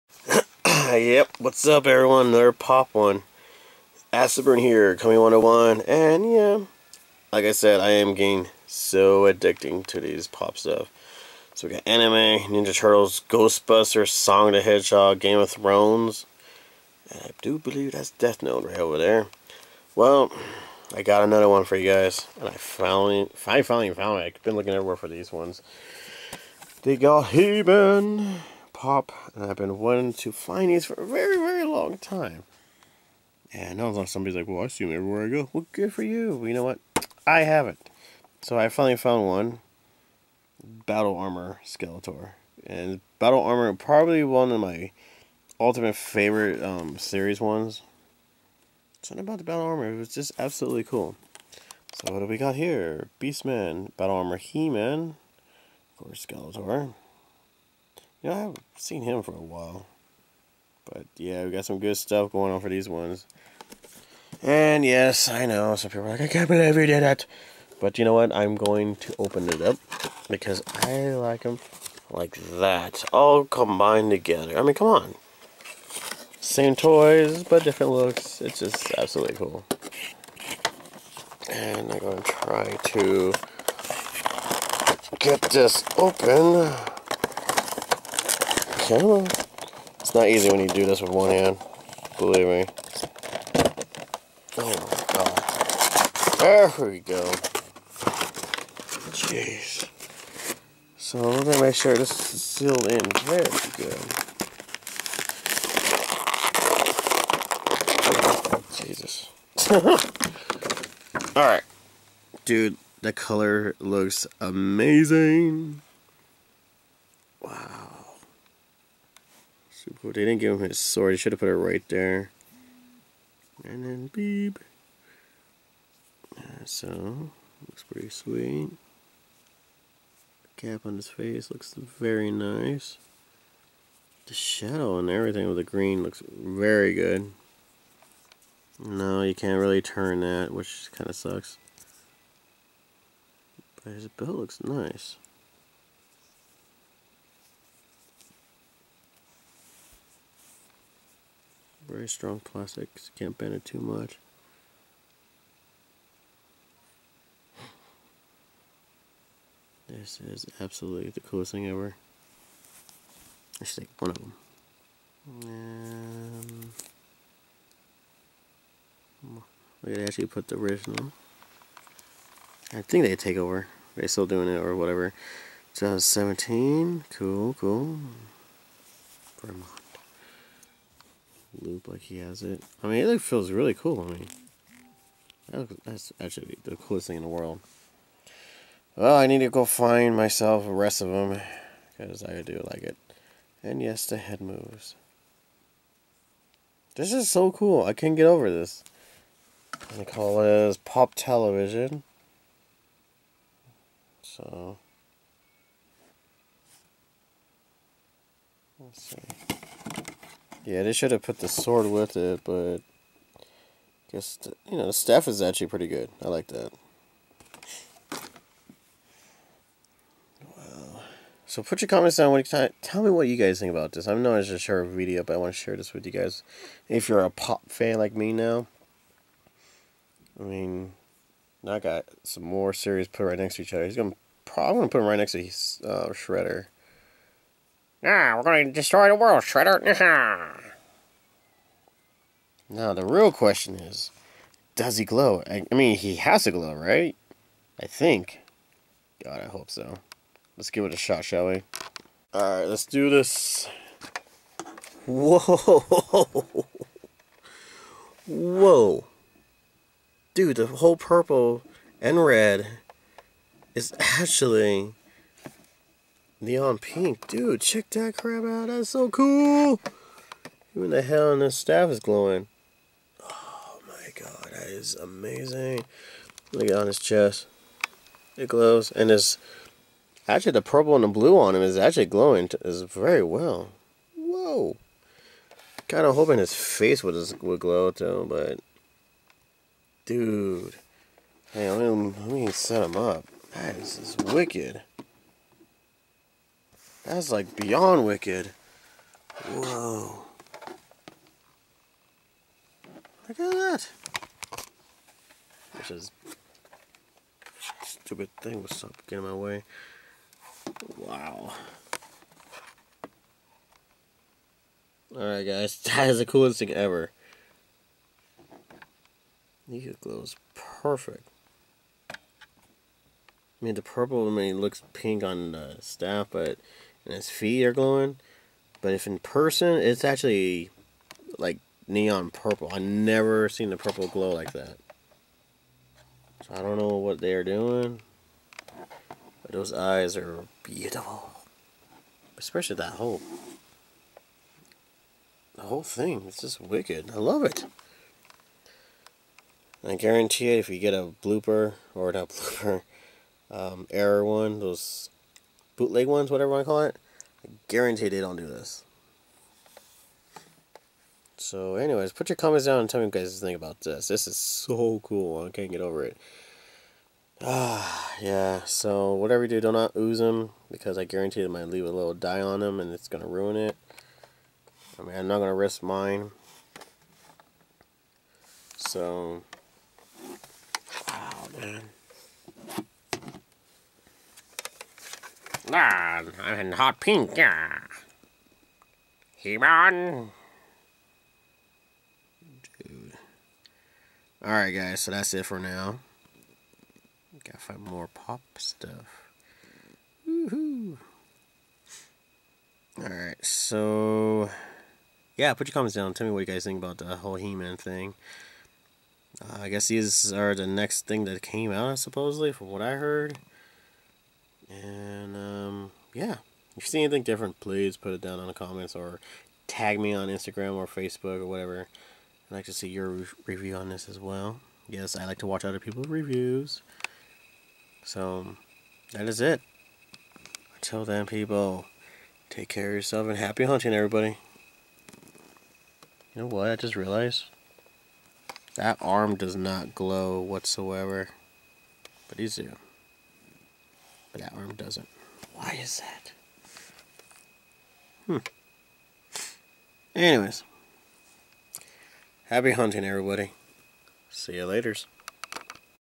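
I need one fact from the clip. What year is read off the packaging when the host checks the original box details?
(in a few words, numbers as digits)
2017.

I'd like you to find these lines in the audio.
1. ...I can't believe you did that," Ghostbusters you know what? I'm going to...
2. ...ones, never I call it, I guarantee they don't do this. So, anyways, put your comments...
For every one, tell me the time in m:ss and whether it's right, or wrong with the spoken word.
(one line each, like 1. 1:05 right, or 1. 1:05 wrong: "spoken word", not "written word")
1. 1:06 wrong: "But", not "Ghostbusters"
2. 5:56 wrong: "whatever", not "never".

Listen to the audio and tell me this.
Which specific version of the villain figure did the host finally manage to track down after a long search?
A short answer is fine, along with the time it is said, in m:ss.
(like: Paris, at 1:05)
Battle Armor Skeletor, at 0:40.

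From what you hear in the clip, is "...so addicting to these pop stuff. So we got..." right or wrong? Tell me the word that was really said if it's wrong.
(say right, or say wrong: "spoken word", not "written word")
right.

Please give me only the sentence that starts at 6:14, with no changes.
I mean, I'm not going to risk mine.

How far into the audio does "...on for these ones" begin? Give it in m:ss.
1:02.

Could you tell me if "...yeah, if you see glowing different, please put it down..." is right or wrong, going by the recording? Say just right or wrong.
wrong.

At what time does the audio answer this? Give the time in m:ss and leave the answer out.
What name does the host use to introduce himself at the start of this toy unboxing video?
0:04.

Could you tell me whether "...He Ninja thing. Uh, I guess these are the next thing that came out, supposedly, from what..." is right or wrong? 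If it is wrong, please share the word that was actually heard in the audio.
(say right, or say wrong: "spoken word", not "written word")
wrong: "Man", not "Ninja".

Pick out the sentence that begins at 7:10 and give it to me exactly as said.
Until then, people, take care of yourself and happy hunting, everybody.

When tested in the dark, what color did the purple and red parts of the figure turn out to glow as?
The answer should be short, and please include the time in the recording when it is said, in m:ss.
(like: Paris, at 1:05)
Neon pink, at 4:26.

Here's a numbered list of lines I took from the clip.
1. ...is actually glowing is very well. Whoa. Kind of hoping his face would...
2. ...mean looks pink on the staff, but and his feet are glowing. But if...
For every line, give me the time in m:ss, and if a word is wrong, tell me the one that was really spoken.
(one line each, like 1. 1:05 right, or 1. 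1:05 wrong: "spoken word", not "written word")
1. 4:41 right
2. 5:24 right.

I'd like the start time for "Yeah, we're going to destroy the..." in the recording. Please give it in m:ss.
3:58.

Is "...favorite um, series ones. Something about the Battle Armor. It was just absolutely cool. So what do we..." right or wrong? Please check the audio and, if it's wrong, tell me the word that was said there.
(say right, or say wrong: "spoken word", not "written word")
right.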